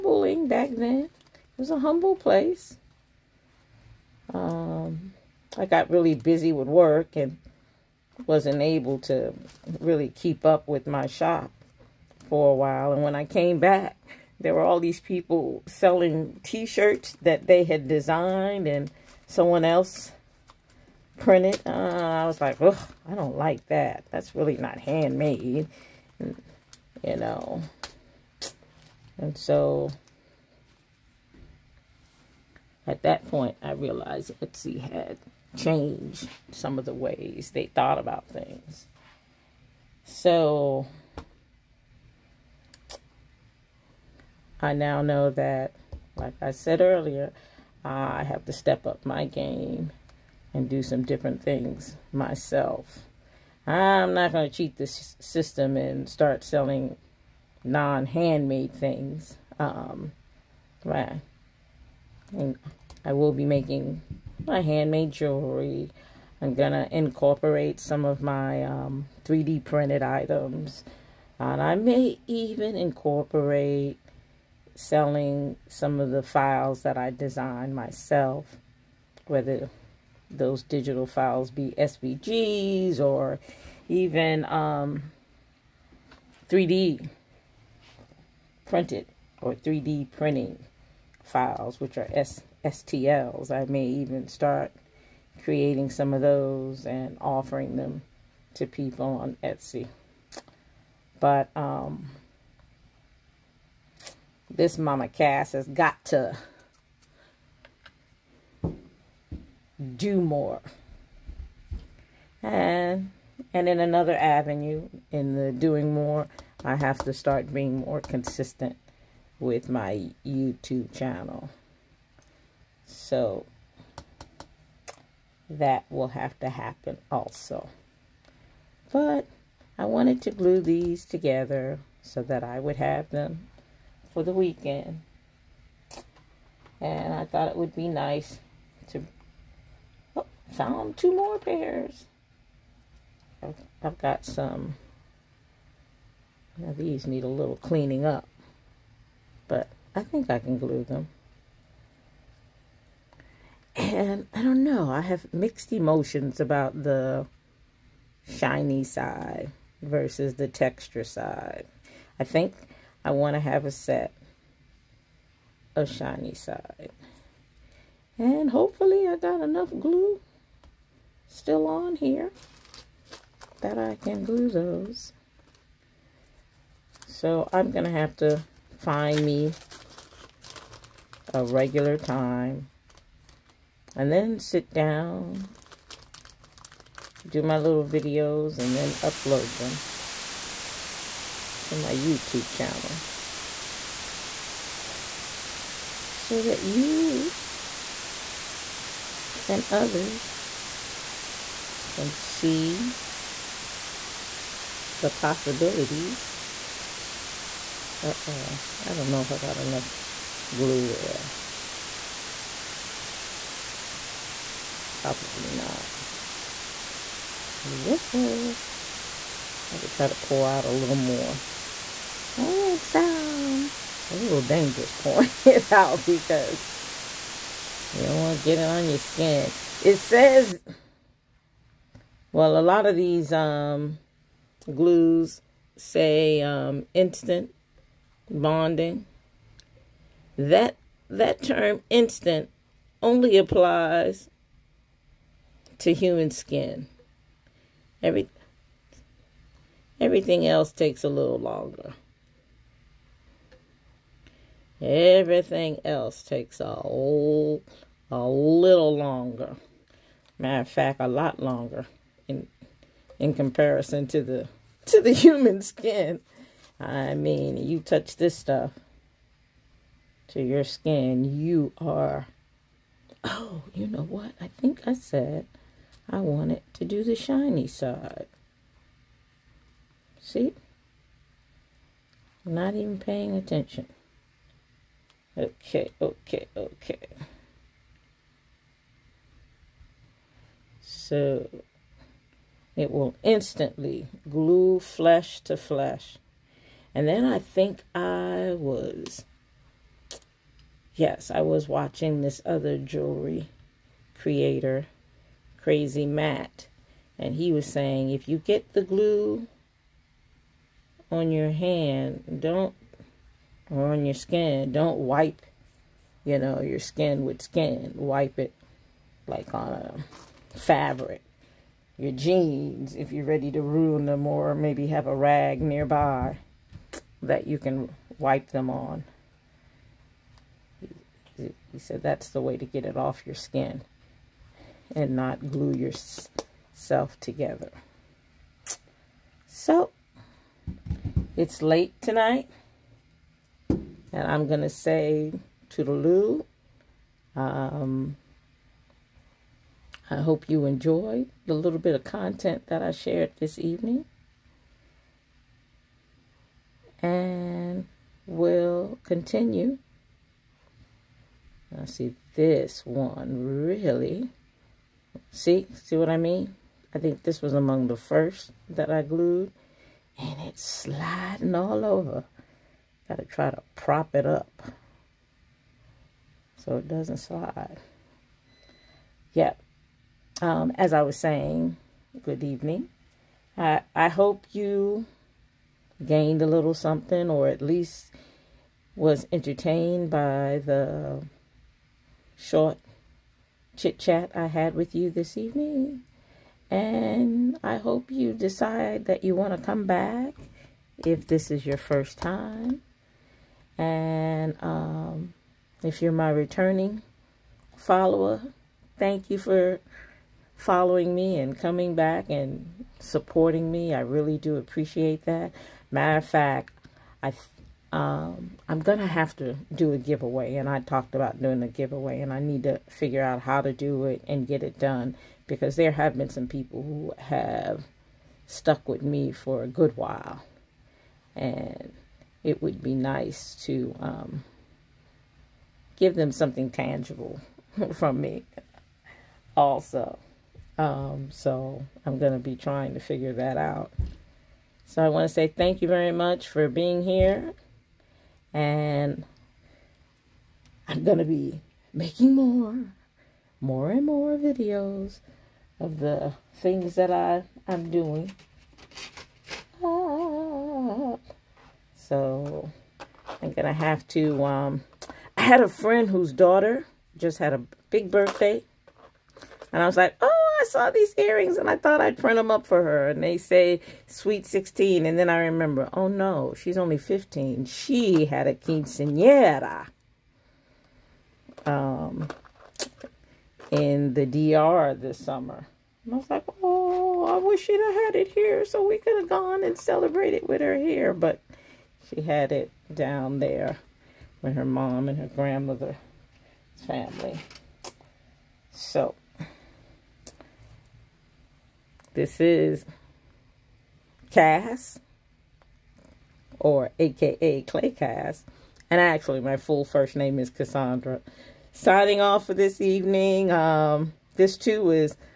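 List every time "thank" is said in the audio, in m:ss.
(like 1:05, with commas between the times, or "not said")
6:48, 7:25.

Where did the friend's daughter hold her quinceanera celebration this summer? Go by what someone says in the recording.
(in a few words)
The DR.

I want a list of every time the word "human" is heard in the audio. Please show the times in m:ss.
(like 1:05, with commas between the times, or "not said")
4:05, 4:25.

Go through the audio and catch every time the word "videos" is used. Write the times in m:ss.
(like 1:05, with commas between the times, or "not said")
3:07, 7:34.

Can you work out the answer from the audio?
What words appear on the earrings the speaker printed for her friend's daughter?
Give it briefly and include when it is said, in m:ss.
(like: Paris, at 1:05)
Sweet 16, at 7:54.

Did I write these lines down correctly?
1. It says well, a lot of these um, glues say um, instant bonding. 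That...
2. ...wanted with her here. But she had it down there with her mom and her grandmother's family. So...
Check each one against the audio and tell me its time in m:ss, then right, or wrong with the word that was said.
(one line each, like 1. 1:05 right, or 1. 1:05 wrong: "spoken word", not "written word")
1. 3:49 right
2. 8:09 wrong: "celebrated", not "wanted".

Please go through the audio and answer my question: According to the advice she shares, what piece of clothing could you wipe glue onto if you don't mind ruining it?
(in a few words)
Jeans.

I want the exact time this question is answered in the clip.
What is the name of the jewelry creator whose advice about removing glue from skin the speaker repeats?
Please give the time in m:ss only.
5:05.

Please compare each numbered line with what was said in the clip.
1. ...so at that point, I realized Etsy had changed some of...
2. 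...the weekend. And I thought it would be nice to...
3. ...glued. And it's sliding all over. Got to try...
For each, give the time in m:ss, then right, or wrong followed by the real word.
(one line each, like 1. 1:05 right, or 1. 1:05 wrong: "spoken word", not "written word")
1. 0:29 right
2. 2:14 right
3. 6:09 right.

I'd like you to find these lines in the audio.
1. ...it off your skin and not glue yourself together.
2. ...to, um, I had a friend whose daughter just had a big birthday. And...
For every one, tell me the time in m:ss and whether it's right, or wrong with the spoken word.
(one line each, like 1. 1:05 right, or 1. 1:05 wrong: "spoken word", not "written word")
1. 5:32 right
2. 7:44 right.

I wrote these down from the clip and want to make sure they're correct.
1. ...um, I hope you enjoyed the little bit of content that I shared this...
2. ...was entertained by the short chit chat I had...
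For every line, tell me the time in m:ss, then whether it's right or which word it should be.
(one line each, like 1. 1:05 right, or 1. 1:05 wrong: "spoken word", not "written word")
1. 5:47 right
2. 6:28 right.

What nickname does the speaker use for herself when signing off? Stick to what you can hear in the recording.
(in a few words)
Clay Cass.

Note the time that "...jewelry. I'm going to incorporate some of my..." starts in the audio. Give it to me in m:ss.
1:05.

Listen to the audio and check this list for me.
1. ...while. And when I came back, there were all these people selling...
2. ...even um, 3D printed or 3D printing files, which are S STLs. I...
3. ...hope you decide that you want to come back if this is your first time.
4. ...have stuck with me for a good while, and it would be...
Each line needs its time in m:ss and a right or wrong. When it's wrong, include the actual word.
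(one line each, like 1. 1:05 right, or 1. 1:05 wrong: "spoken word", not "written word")
1. 0:12 right
2. 1:23 right
3. 6:37 right
4. 7:07 right.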